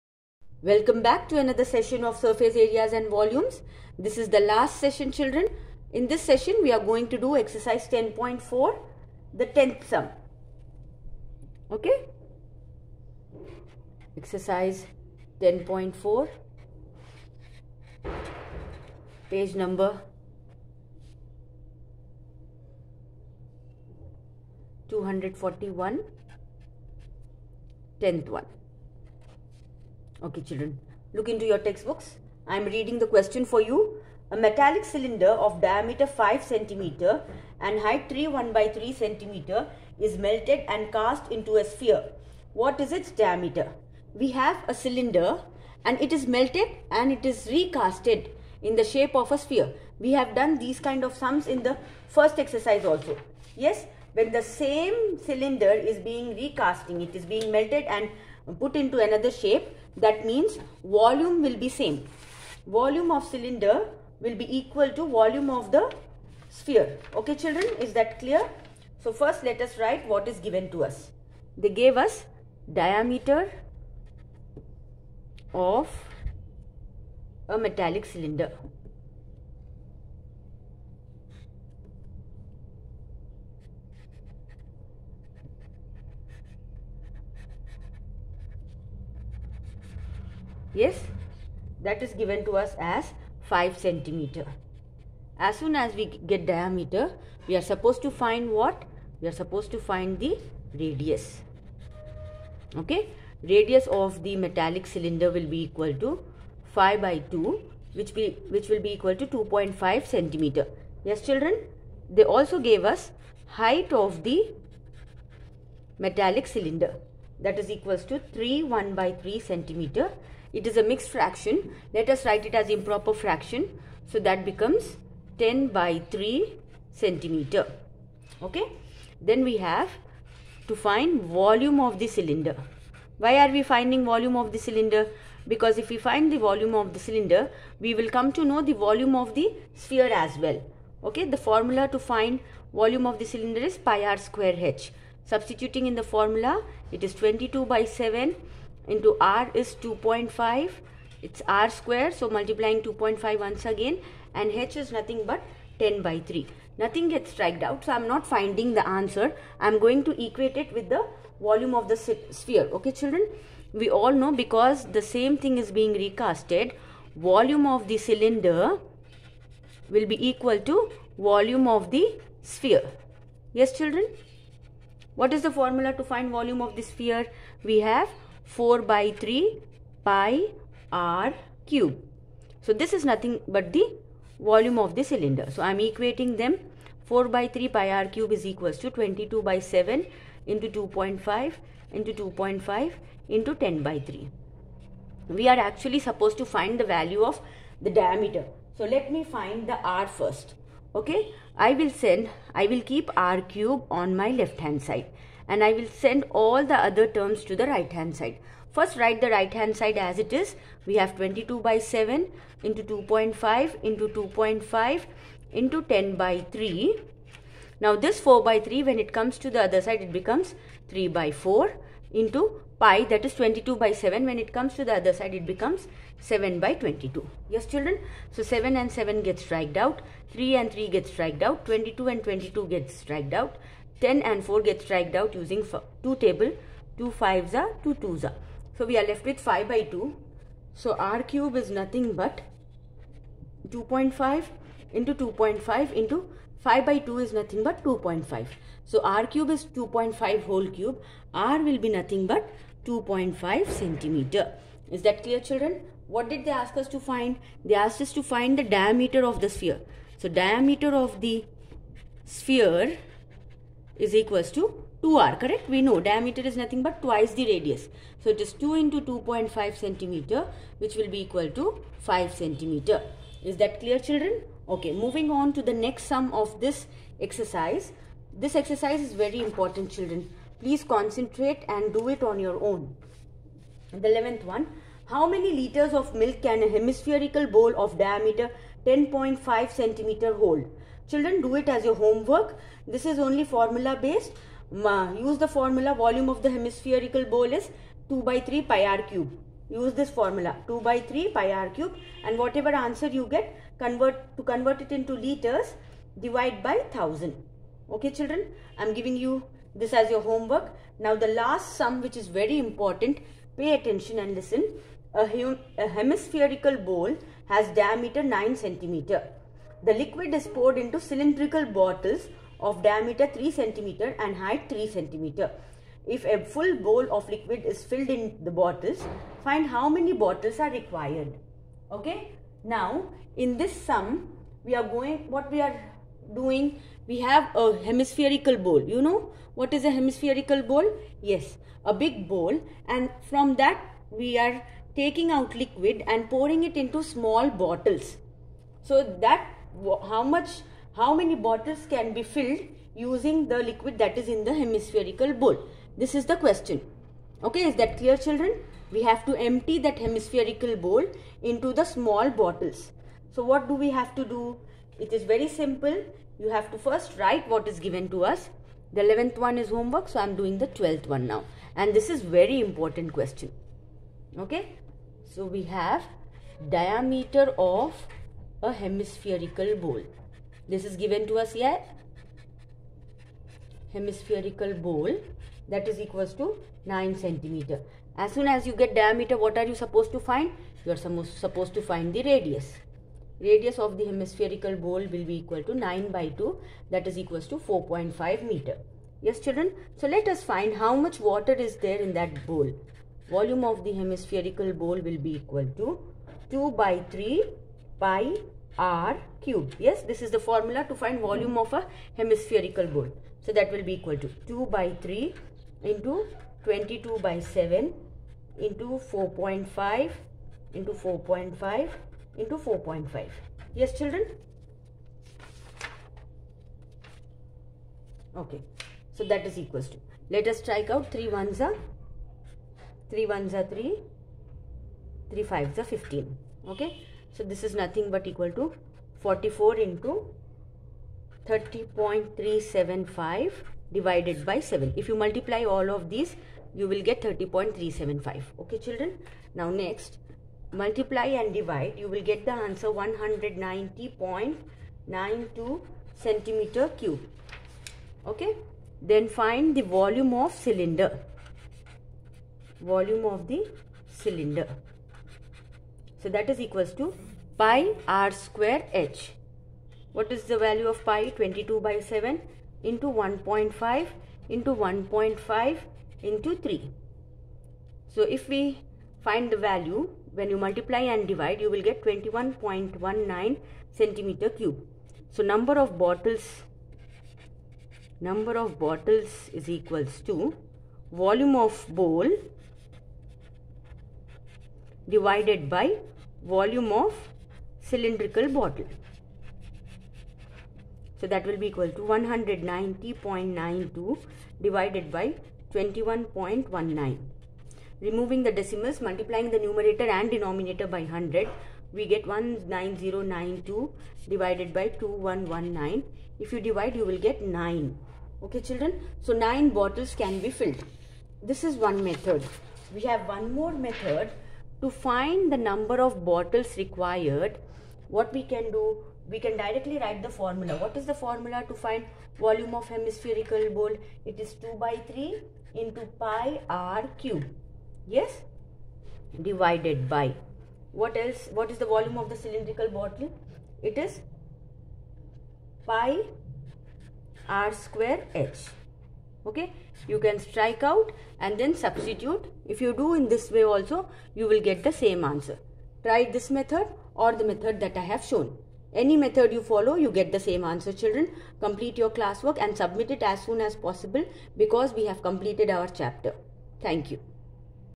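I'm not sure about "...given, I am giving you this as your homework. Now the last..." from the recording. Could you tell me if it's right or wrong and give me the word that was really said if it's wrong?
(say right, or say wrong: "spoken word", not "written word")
wrong: "children", not "given".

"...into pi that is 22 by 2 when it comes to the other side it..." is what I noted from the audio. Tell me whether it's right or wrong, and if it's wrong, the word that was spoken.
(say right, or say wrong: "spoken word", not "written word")
wrong: "7", not "2".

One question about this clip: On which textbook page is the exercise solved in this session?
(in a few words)
241.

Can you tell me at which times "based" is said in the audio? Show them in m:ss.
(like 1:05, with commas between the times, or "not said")
4:54.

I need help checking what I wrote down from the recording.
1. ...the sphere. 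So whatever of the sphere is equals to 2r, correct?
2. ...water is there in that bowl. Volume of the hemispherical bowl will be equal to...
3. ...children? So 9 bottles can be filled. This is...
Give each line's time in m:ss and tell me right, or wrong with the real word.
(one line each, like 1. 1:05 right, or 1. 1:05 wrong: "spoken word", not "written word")
1. 4:19 wrong: "diameter", not "whatever"
2. 6:41 right
3. 8:38 right.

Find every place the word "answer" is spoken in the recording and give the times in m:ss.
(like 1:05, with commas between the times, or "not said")
2:38, 5:02, 7:32, 9:15, 9:20.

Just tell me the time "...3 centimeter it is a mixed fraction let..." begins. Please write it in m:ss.
1:59.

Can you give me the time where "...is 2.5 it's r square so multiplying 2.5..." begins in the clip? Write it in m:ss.
2:29.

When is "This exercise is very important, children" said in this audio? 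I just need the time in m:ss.
4:38.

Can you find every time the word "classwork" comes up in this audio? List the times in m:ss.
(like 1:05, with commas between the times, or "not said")
9:22.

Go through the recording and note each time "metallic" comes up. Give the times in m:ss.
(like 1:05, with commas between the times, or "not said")
0:34, 1:17, 1:44, 1:55.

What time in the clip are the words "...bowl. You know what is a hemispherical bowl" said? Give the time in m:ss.
5:38.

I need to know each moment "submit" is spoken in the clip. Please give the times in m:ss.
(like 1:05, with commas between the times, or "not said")
9:22.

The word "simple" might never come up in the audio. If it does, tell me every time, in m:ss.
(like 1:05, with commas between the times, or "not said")
6:05.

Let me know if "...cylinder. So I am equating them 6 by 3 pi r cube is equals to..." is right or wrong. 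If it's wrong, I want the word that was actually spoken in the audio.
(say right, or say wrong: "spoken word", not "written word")
wrong: "4", not "6".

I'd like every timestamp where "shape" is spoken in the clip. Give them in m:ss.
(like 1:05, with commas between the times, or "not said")
0:48, 0:59.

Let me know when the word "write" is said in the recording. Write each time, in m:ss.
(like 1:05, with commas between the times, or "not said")
1:09, 2:02, 3:28, 6:07, 8:49.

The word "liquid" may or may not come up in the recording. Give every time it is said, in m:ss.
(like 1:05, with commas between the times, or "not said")
5:19, 5:27, 5:45, 5:53.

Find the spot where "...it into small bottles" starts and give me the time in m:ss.
5:46.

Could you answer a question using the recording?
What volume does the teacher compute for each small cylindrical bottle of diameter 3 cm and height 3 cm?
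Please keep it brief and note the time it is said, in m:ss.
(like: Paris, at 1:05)
21.19 cubic cm, at 8:02.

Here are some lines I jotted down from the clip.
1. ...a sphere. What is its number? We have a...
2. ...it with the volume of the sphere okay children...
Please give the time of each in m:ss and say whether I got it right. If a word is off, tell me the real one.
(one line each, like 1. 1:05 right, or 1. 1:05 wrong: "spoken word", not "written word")
1. 0:41 wrong: "diameter", not "number"
2. 2:40 right.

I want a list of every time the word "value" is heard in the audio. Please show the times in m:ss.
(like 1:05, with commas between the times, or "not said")
3:16, 7:50, 7:59.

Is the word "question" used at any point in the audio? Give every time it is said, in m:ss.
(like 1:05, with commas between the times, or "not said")
0:33, 5:56, 6:13.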